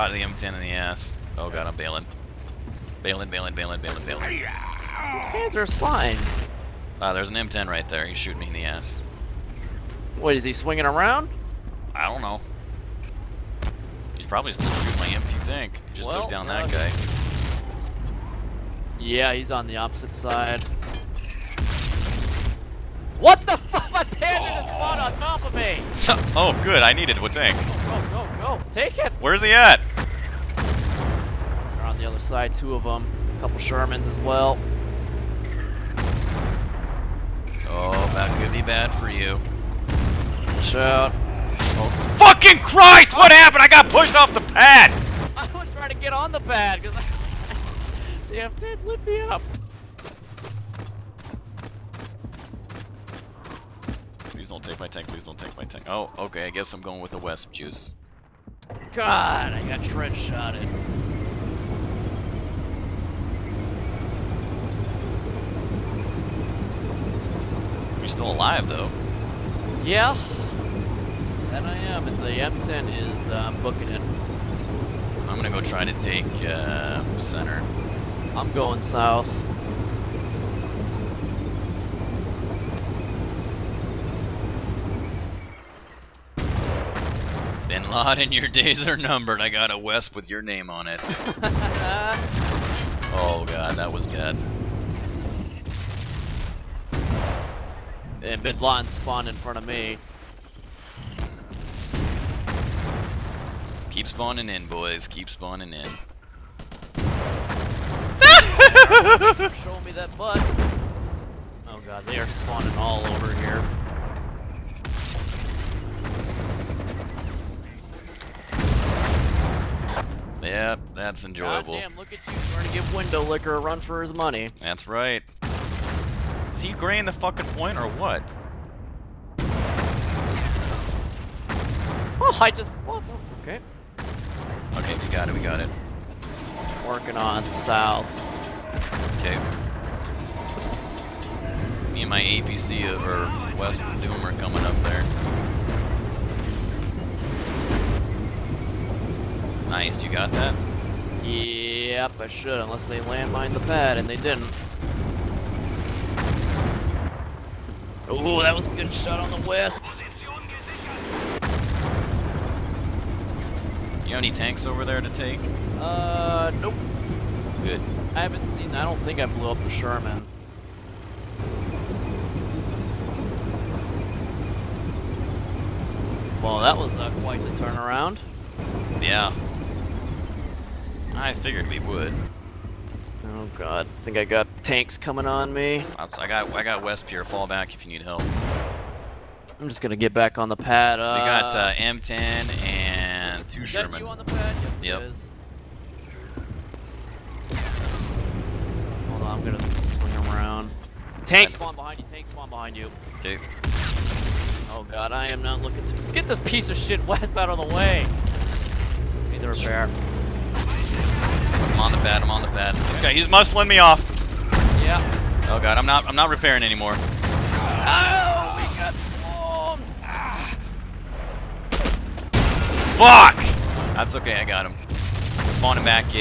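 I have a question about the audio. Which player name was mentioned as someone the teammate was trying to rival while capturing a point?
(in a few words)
Window Licker.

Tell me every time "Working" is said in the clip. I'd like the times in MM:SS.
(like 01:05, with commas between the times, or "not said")
02:16.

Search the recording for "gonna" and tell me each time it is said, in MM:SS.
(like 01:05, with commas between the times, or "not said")
01:15, 03:09, 03:19.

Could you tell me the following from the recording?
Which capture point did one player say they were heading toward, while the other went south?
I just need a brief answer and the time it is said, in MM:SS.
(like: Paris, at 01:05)
Center, at 01:17.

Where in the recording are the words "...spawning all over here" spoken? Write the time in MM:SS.
01:52.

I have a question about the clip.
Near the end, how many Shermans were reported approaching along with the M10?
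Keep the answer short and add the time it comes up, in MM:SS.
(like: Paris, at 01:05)
2, at 03:13.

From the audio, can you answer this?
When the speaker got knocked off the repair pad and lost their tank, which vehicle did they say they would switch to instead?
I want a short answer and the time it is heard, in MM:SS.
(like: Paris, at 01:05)
Wespe, at 00:57.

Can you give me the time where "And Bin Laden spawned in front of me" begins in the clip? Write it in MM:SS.
01:38.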